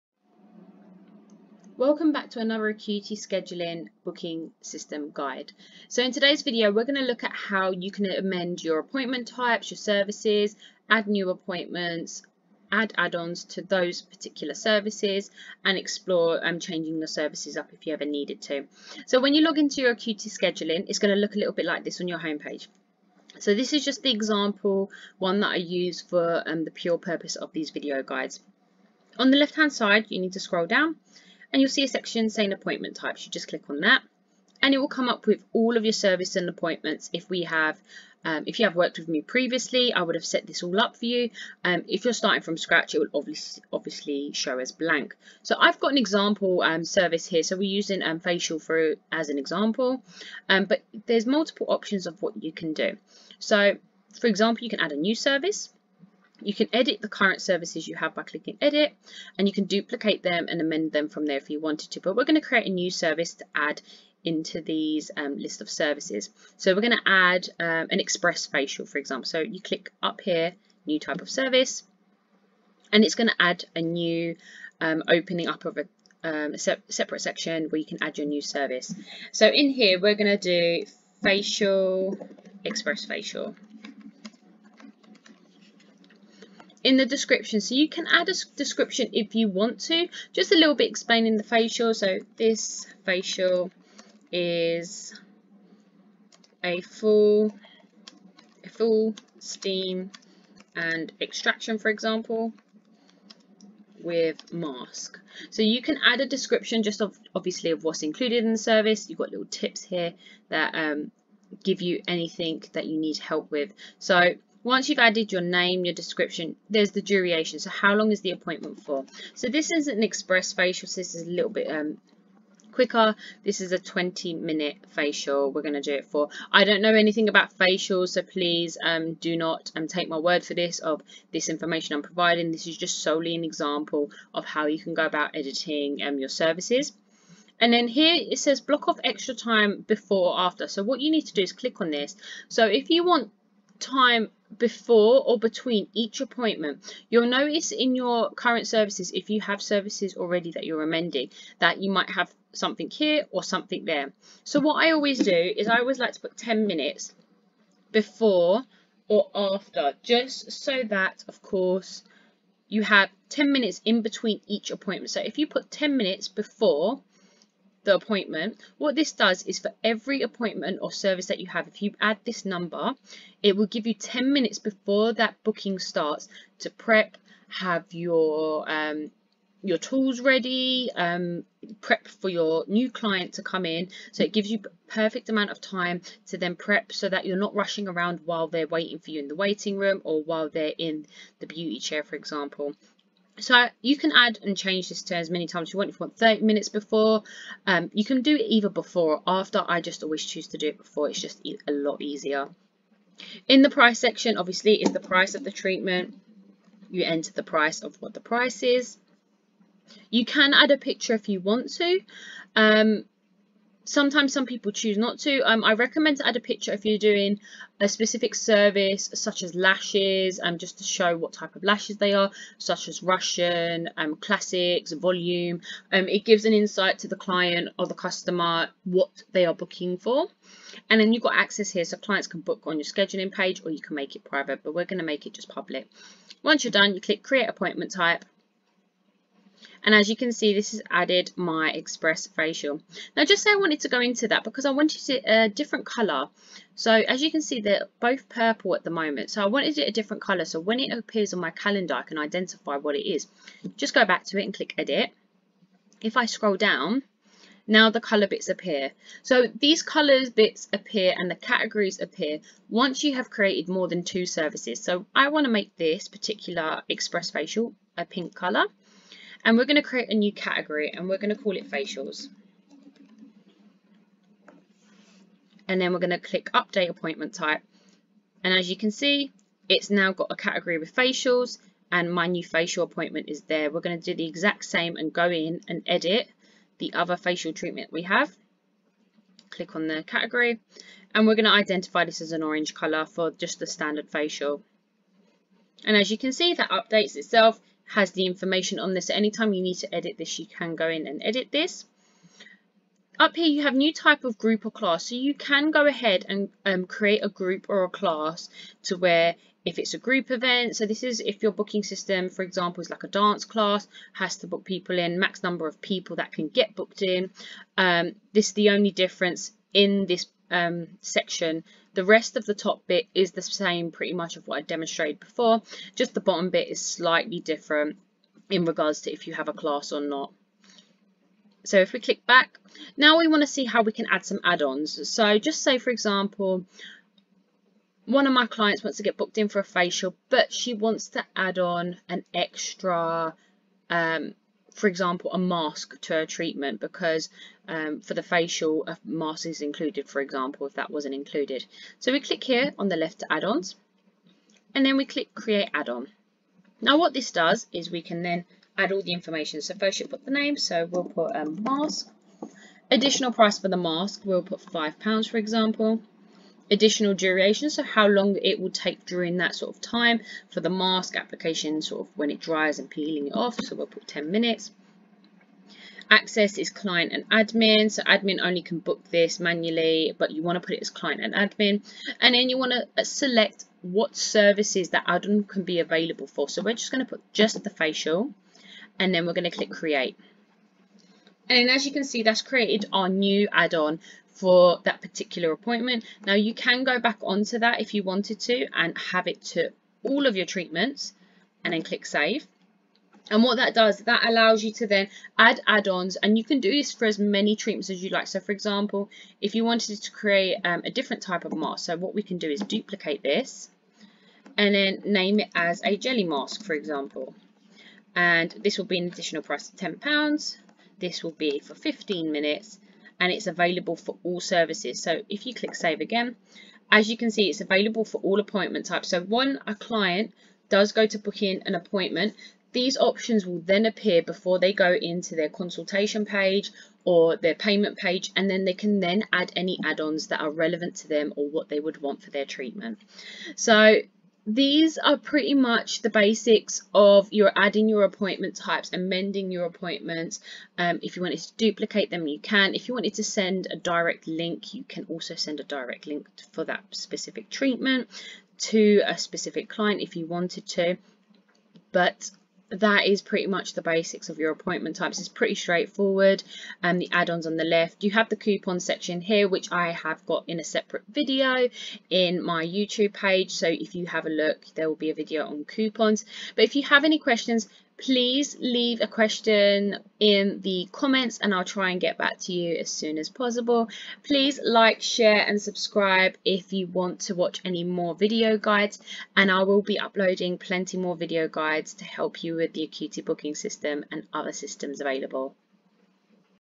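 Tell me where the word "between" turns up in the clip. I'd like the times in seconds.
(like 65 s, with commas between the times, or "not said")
145 s, 164 s.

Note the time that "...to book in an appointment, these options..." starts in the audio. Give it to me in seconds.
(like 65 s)
431 s.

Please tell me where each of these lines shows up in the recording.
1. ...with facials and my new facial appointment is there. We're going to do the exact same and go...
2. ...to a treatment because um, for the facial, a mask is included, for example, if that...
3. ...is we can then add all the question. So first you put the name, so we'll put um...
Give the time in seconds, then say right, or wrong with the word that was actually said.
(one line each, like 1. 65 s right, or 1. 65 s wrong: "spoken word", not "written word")
1. 280 s right
2. 346 s right
3. 357 s wrong: "information", not "question".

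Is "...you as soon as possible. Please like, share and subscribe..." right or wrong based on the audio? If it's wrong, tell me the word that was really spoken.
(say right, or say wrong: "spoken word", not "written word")
right.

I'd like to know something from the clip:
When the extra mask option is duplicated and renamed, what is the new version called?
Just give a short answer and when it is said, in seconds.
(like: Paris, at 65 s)
Jelly mask, at 415 s.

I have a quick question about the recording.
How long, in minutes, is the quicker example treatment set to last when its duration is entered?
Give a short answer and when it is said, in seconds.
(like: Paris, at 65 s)
20 minutes, at 123 s.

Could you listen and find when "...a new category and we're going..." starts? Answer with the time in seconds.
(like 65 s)
270 s.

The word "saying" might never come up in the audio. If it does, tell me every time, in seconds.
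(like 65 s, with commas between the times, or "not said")
32 s.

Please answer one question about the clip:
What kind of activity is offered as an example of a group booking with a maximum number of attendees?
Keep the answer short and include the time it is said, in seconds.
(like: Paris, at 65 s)
Dance class, at 313 s.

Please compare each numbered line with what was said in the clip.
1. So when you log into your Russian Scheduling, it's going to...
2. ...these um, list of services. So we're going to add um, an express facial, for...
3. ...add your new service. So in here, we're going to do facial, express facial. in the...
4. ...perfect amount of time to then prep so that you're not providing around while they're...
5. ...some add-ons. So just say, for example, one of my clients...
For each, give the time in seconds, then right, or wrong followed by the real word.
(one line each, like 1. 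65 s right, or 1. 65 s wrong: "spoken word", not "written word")
1. 19 s wrong: "Acuity", not "Russian"
2. 64 s right
3. 78 s right
4. 184 s wrong: "rushing", not "providing"
5. 334 s right.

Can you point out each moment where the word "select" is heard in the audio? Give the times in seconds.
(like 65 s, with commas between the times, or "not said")
383 s.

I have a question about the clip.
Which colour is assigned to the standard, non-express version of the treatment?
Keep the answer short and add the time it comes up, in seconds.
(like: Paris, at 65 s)
Orange, at 292 s.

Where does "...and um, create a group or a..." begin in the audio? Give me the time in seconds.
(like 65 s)
306 s.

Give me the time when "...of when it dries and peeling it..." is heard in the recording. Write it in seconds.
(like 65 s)
372 s.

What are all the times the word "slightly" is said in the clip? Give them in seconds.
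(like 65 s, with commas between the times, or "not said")
326 s.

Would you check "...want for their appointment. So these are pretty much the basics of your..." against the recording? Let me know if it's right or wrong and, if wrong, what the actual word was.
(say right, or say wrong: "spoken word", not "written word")
wrong: "treatment", not "appointment".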